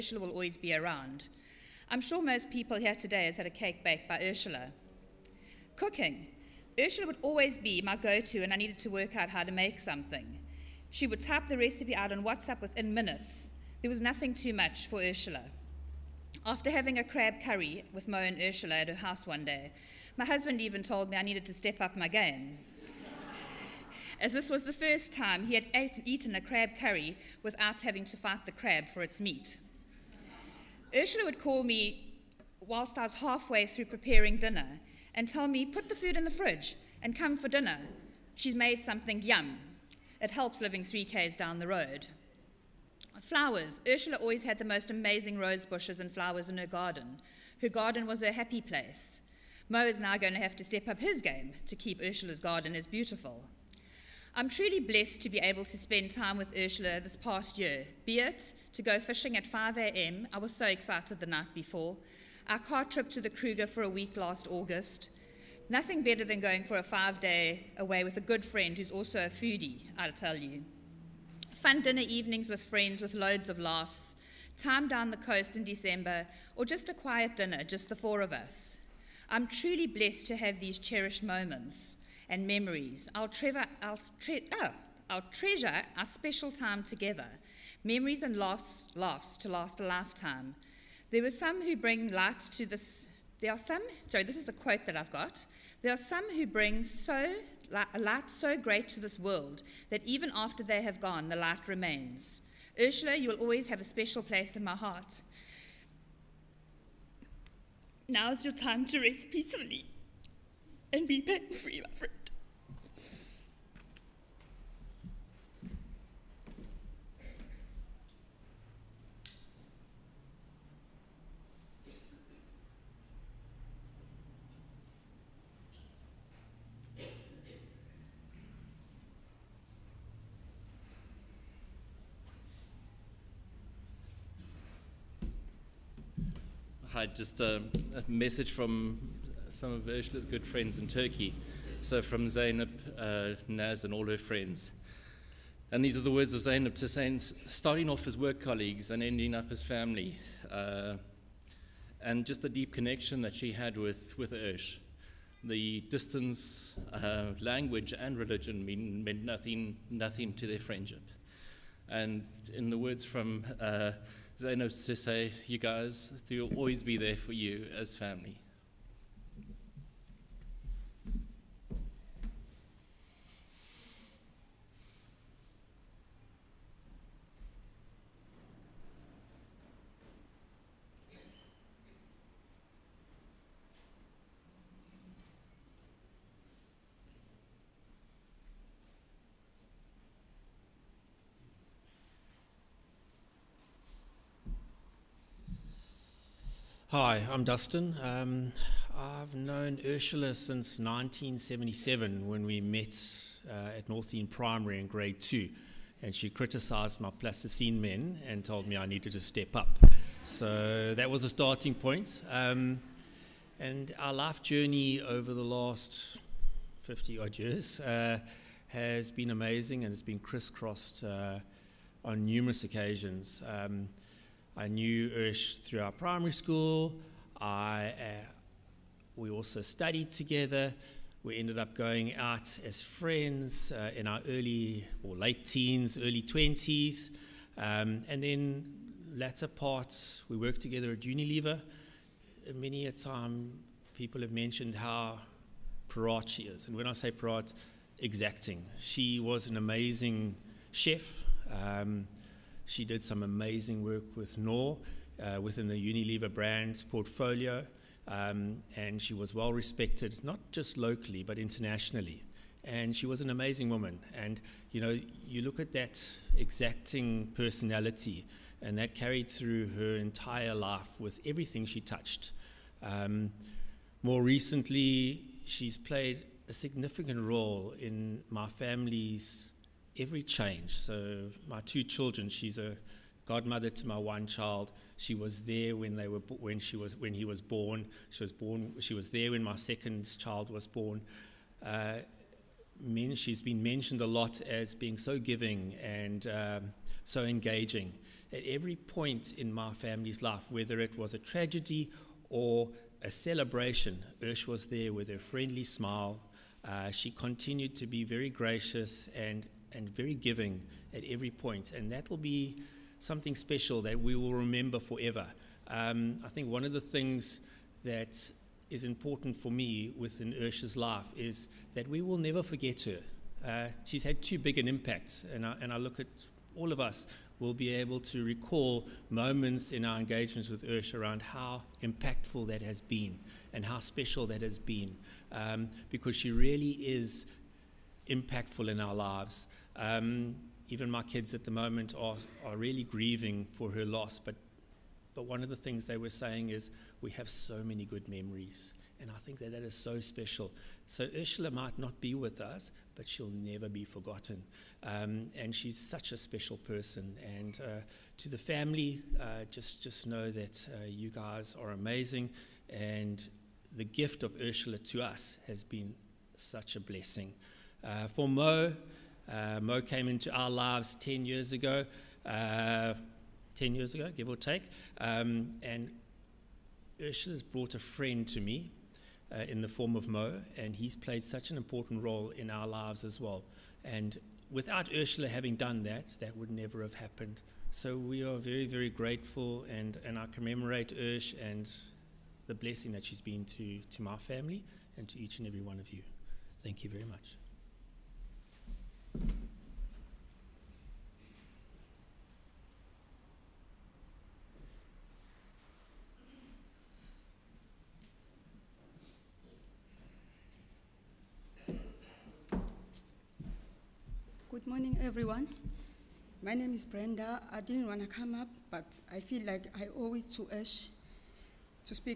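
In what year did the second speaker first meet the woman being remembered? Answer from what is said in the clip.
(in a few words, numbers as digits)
1977.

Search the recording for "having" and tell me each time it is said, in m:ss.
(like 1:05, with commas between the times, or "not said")
0:16, 0:27, 6:25.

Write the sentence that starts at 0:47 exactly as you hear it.
Her garden was her happy place.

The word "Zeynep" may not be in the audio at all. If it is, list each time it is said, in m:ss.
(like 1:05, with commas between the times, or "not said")
2:22, 2:26.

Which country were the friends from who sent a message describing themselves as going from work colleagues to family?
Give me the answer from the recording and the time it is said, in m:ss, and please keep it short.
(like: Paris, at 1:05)
Turkey, at 2:20.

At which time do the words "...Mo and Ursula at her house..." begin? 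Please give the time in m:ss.
0:18.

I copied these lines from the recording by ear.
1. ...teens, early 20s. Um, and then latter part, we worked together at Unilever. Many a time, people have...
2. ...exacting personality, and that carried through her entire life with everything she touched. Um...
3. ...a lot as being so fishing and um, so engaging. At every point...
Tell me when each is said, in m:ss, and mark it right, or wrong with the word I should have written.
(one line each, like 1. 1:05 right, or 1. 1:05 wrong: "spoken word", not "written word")
1. 3:55 right
2. 4:26 right
3. 4:53 wrong: "giving", not "fishing".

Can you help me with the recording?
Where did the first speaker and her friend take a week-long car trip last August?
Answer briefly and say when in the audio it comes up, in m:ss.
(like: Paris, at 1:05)
The Kruger, at 1:03.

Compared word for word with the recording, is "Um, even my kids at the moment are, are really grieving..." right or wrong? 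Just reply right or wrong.
right.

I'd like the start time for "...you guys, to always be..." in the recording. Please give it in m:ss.
2:45.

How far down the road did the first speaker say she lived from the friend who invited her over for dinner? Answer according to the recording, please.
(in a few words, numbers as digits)
3Ks.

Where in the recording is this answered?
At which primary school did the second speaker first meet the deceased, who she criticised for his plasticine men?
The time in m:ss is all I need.
3:23.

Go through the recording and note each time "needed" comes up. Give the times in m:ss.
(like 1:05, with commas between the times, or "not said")
0:08, 0:21, 3:28.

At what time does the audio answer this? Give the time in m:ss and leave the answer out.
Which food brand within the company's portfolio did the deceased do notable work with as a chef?
4:14.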